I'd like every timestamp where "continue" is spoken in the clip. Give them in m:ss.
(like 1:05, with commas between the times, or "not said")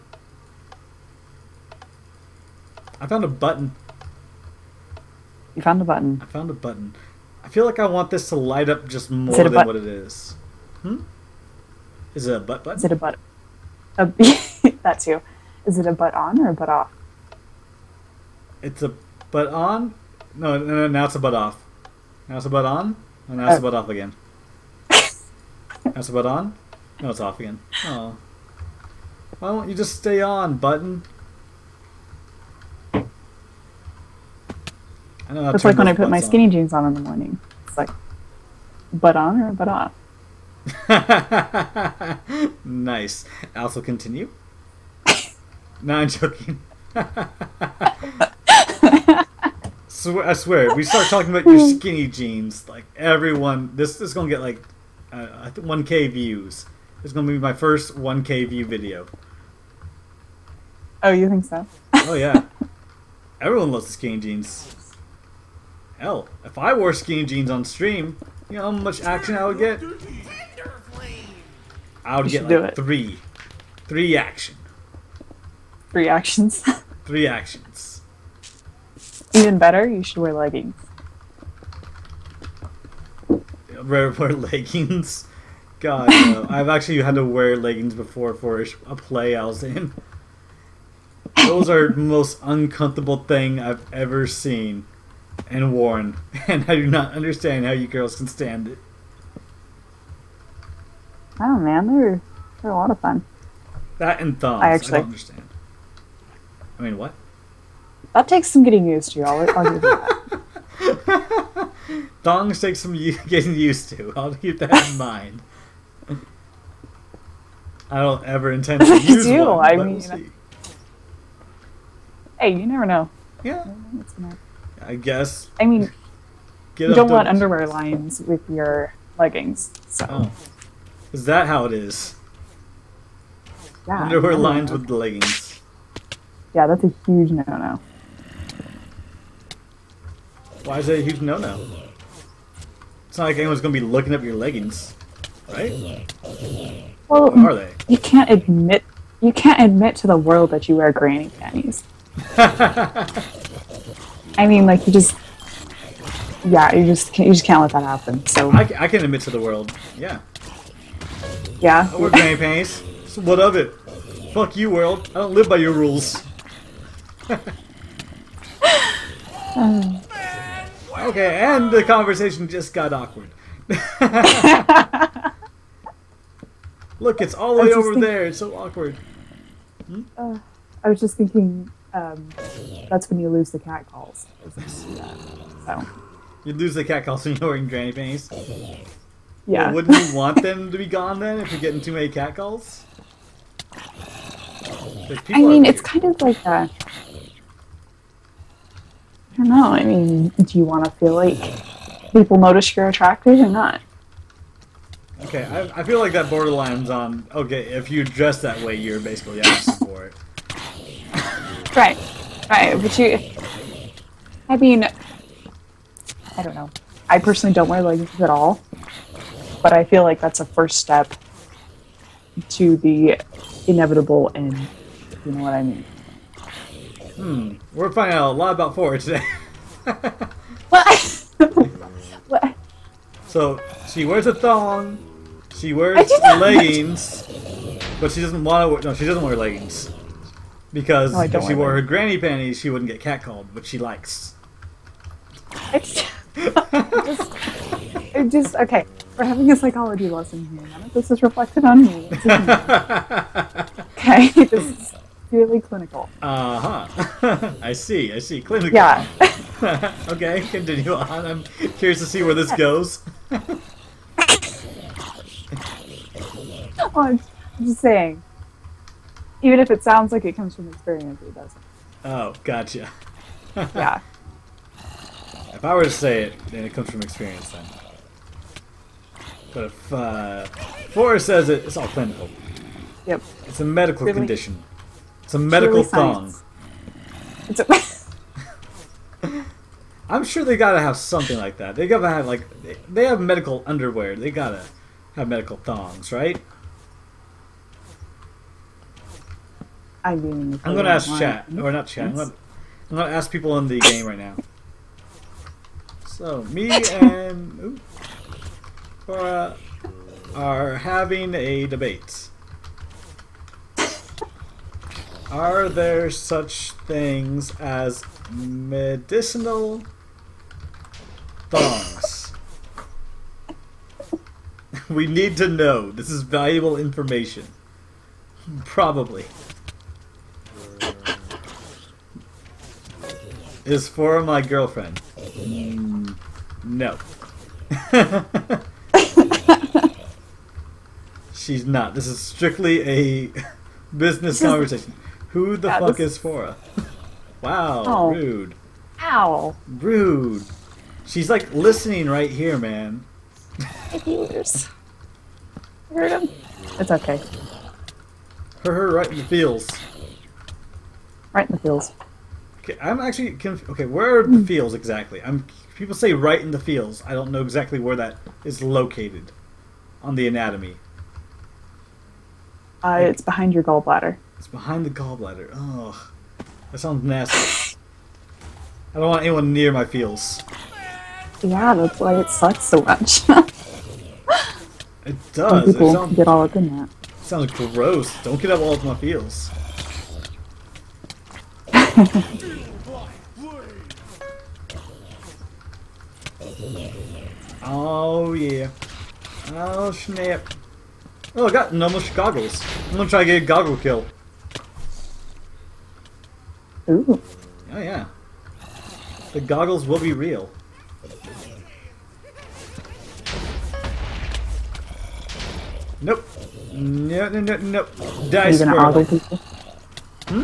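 0:43, 4:20.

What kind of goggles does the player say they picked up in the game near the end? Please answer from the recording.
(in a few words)
Normal goggles.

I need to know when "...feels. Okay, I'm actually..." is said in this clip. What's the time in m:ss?
6:01.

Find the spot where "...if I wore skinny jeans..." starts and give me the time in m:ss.
1:06.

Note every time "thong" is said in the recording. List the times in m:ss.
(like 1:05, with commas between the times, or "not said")
1:52, 3:54, 4:46, 4:55, 5:21.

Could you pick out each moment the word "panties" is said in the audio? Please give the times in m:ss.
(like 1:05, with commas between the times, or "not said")
2:31, 2:42, 3:07, 4:02.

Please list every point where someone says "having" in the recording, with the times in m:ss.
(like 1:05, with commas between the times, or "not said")
4:09, 5:10.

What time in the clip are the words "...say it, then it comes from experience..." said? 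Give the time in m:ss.
4:35.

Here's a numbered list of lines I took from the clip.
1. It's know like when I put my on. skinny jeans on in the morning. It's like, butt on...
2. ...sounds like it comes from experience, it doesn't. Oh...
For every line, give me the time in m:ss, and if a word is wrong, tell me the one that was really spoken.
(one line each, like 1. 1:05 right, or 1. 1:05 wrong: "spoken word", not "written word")
1. 0:35 right
2. 4:29 right.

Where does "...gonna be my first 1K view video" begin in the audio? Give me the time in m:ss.
0:57.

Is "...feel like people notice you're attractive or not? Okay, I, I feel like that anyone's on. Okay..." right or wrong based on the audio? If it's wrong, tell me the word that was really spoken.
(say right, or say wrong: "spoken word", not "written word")
wrong: "borderline", not "anyone".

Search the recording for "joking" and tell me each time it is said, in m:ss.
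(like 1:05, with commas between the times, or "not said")
0:46.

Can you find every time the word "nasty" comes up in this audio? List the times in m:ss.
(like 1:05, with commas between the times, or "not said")
6:17.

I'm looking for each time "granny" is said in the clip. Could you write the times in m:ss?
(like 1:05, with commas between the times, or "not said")
2:30, 2:42, 3:07, 4:01.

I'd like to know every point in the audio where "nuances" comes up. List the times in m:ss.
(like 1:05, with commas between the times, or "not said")
not said.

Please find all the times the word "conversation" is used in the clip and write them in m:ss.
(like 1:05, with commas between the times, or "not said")
2:51, 5:44.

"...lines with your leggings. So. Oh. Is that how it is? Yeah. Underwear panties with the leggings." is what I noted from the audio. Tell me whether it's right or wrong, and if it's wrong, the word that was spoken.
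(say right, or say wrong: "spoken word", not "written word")
wrong: "lines", not "panties".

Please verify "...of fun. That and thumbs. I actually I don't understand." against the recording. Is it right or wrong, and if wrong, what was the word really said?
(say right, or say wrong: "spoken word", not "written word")
right.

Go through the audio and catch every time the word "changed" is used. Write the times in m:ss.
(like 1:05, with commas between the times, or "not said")
not said.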